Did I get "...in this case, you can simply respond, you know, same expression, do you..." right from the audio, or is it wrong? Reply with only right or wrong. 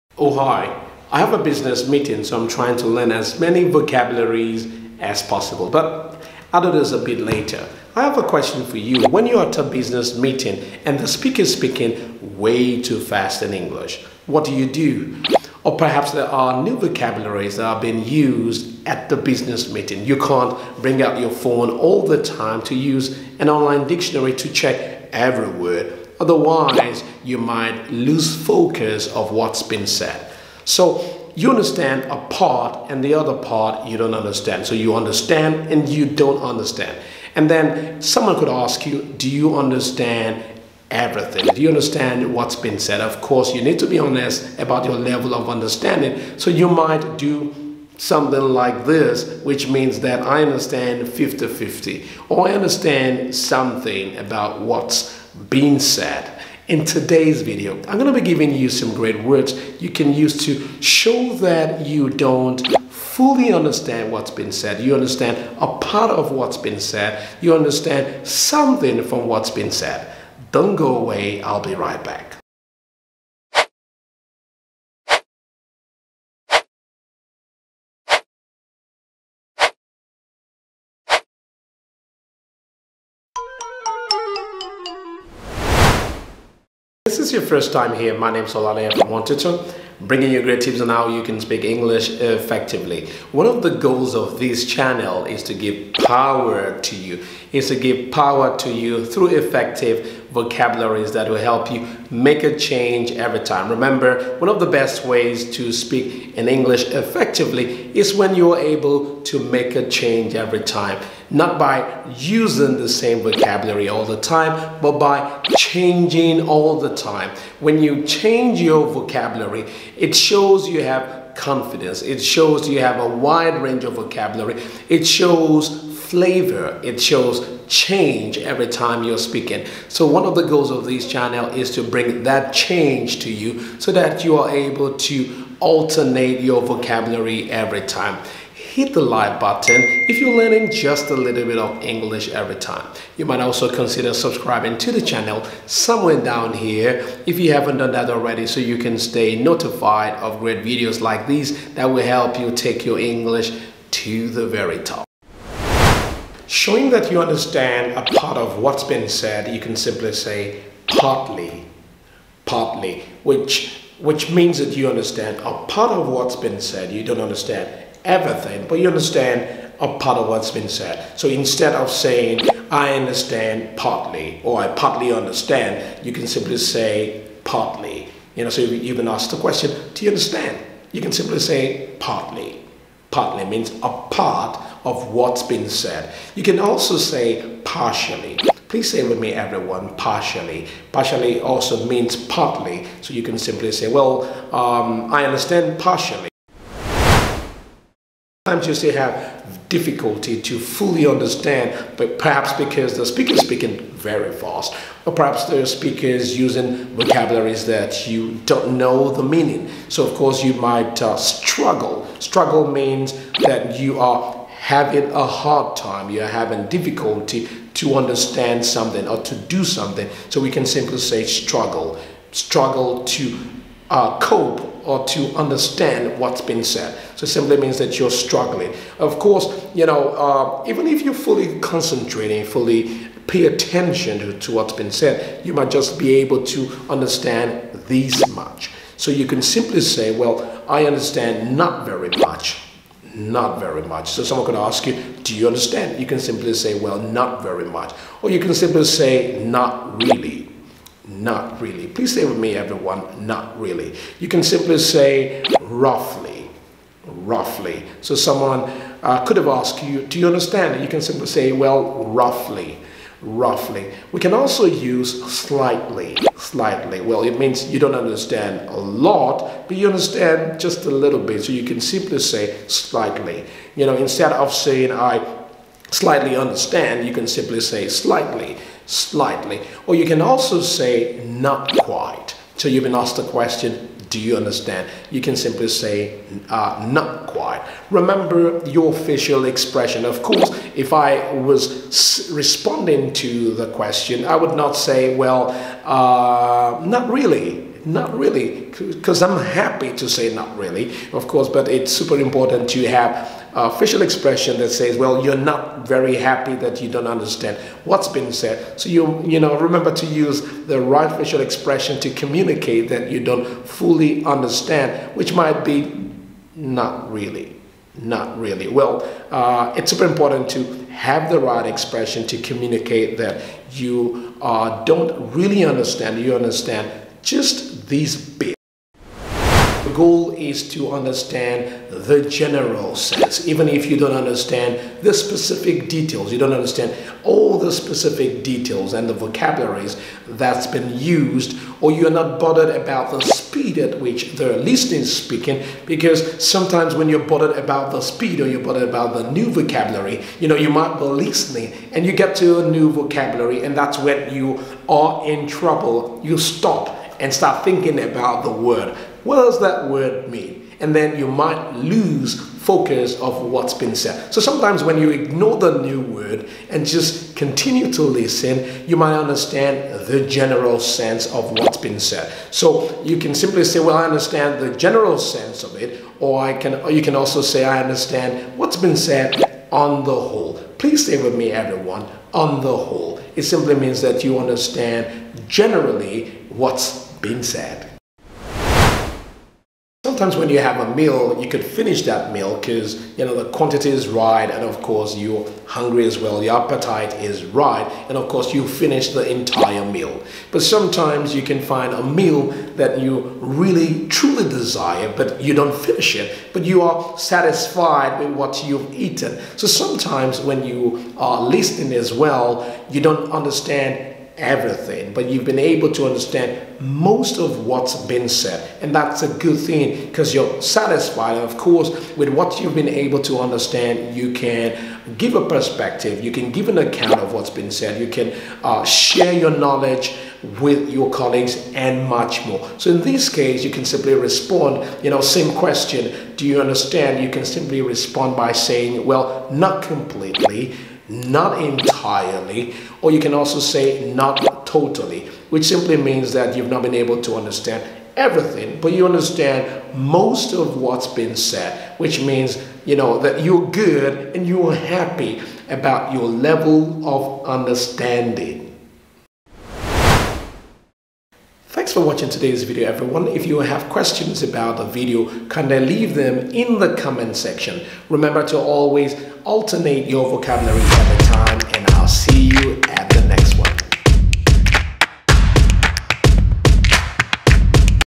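wrong.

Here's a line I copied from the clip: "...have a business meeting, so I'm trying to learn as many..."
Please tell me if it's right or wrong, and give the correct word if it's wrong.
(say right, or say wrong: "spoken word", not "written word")
right.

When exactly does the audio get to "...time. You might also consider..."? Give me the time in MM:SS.
02:22.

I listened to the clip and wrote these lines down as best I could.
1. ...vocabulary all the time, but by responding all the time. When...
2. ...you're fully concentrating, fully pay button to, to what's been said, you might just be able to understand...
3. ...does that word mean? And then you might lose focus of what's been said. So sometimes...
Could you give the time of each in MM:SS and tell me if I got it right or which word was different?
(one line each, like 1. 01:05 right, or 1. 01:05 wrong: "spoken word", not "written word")
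1. 01:53 wrong: "changing", not "responding"
2. 03:51 wrong: "attention", not "button"
3. 05:59 right.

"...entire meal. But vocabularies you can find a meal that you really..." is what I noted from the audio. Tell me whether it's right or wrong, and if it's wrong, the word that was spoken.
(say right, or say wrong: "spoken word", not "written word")
wrong: "sometimes", not "vocabularies".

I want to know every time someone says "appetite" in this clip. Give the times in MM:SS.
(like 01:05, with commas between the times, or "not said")
06:36.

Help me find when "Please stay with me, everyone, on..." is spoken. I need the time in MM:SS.
06:20.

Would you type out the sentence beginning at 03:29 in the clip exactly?
So, of course, you might uh, struggle.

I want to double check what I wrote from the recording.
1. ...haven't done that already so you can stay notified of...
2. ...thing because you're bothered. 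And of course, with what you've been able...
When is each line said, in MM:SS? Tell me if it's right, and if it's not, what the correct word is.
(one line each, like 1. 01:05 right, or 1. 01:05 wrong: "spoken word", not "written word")
1. 02:27 right
2. 06:59 wrong: "satisfied", not "bothered".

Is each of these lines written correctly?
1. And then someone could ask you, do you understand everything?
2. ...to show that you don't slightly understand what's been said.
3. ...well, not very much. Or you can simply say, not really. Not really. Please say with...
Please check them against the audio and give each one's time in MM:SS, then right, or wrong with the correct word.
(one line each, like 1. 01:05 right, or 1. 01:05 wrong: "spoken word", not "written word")
1. 00:37 right
2. 01:00 wrong: "fully", not "slightly"
3. 04:06 right.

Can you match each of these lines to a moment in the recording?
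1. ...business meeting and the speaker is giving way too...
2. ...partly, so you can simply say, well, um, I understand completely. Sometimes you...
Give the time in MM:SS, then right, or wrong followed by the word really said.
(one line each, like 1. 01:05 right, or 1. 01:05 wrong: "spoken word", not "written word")
1. 00:09 wrong: "speaking", not "giving"
2. 03:12 wrong: "partially", not "completely".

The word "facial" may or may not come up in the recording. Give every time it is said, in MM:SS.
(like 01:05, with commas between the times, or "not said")
04:48, 05:03, 05:11.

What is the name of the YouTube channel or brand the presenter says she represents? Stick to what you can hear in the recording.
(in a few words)
OneTutor.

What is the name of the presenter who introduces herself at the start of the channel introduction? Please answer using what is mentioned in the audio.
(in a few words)
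Olale.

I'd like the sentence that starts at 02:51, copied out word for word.
So instead of saying I understand partly or I partly understand, you can simply say partly.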